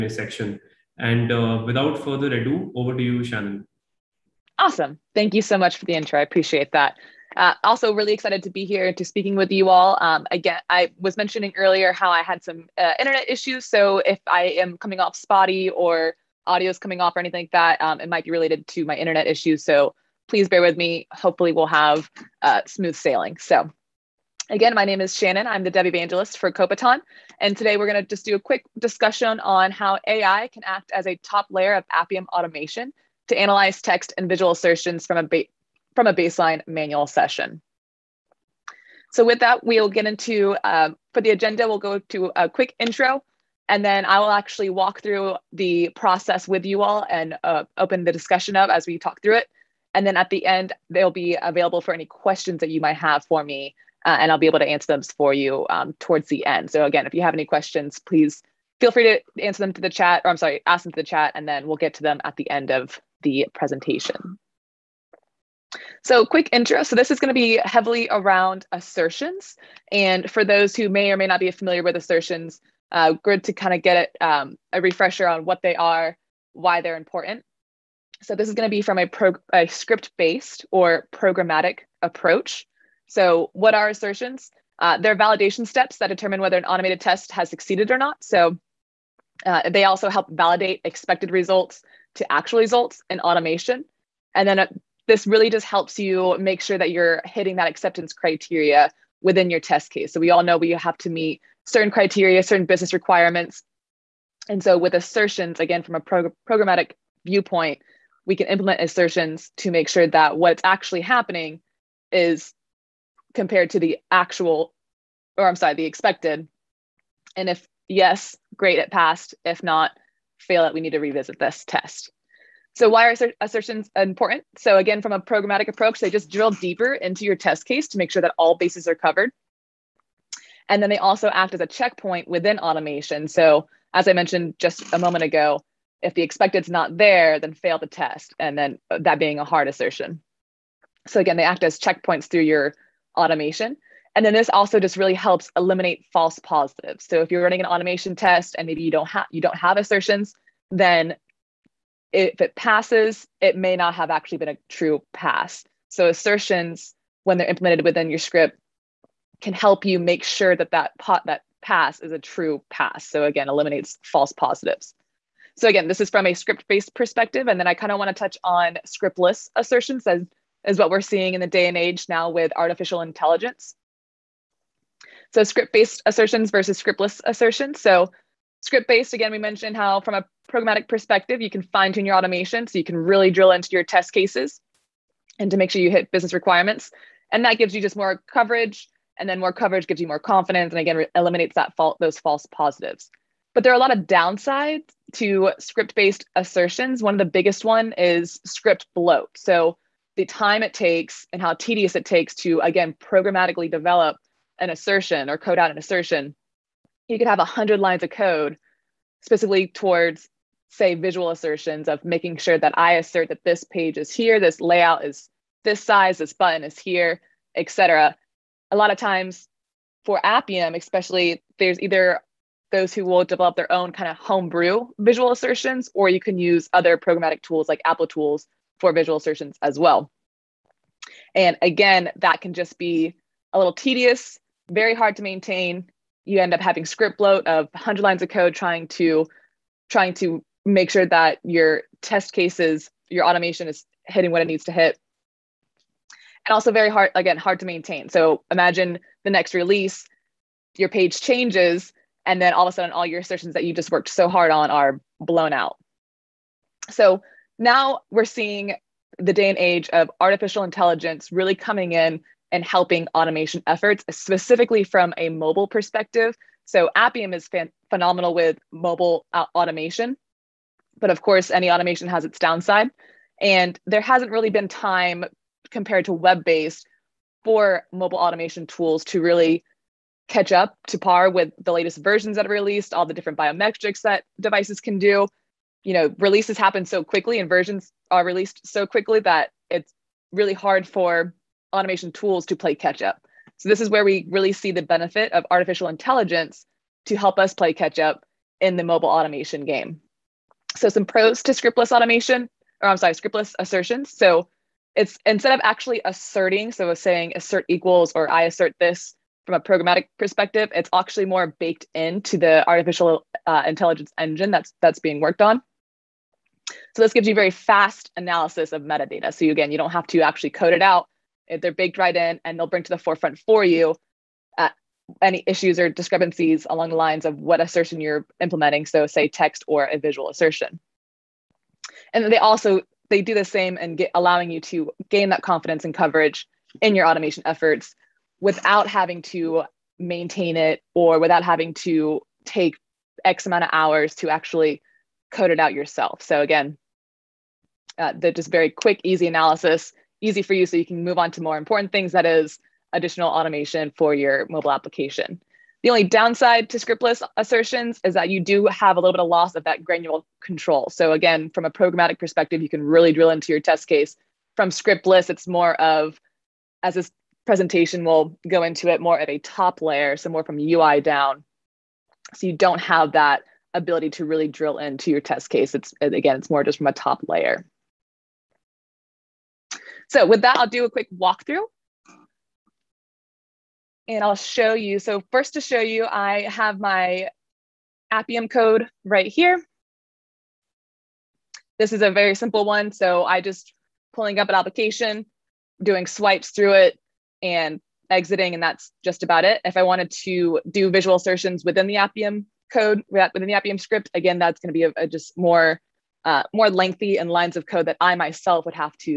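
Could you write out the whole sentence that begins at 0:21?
Hopefully, we'll have uh, smooth sailing.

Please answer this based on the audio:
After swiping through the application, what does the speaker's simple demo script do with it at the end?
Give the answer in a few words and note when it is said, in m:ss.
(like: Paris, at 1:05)
exiting, at 6:38.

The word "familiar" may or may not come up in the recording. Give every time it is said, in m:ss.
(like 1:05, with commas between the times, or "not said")
1:11.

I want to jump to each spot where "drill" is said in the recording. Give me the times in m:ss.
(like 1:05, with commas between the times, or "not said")
2:06, 3:03, 6:03, 6:14.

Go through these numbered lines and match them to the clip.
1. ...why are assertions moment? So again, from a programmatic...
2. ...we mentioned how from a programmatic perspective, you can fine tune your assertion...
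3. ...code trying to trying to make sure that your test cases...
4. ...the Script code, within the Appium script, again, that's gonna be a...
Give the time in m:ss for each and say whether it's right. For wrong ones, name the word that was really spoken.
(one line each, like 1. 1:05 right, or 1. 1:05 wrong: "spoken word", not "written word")
1. 2:02 wrong: "important", not "moment"
2. 2:59 wrong: "automation", not "assertion"
3. 3:58 right
4. 6:41 wrong: "Appium", not "Script".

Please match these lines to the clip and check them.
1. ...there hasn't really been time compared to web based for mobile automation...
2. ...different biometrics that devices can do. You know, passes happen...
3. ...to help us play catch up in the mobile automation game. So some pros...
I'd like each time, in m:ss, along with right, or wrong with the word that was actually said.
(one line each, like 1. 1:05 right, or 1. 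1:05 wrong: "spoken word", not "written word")
1. 4:33 right
2. 4:43 wrong: "releases", not "passes"
3. 4:57 right.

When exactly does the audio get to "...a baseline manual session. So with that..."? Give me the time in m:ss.
0:36.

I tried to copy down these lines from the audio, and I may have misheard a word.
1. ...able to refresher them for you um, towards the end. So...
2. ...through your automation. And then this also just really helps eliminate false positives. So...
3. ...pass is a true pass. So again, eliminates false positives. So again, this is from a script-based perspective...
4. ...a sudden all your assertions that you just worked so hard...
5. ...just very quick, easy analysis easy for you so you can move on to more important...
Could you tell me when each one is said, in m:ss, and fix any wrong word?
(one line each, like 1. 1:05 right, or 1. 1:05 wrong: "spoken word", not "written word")
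1. 0:54 wrong: "answer", not "refresher"
2. 2:22 right
3. 2:41 right
4. 4:12 right
5. 5:48 right.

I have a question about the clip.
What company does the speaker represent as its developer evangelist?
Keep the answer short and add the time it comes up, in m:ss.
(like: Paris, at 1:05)
Kobiton, at 0:26.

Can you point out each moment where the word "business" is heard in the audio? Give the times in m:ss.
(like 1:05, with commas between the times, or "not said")
1:42, 3:06.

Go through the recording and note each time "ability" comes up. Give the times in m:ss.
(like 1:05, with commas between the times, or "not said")
6:13.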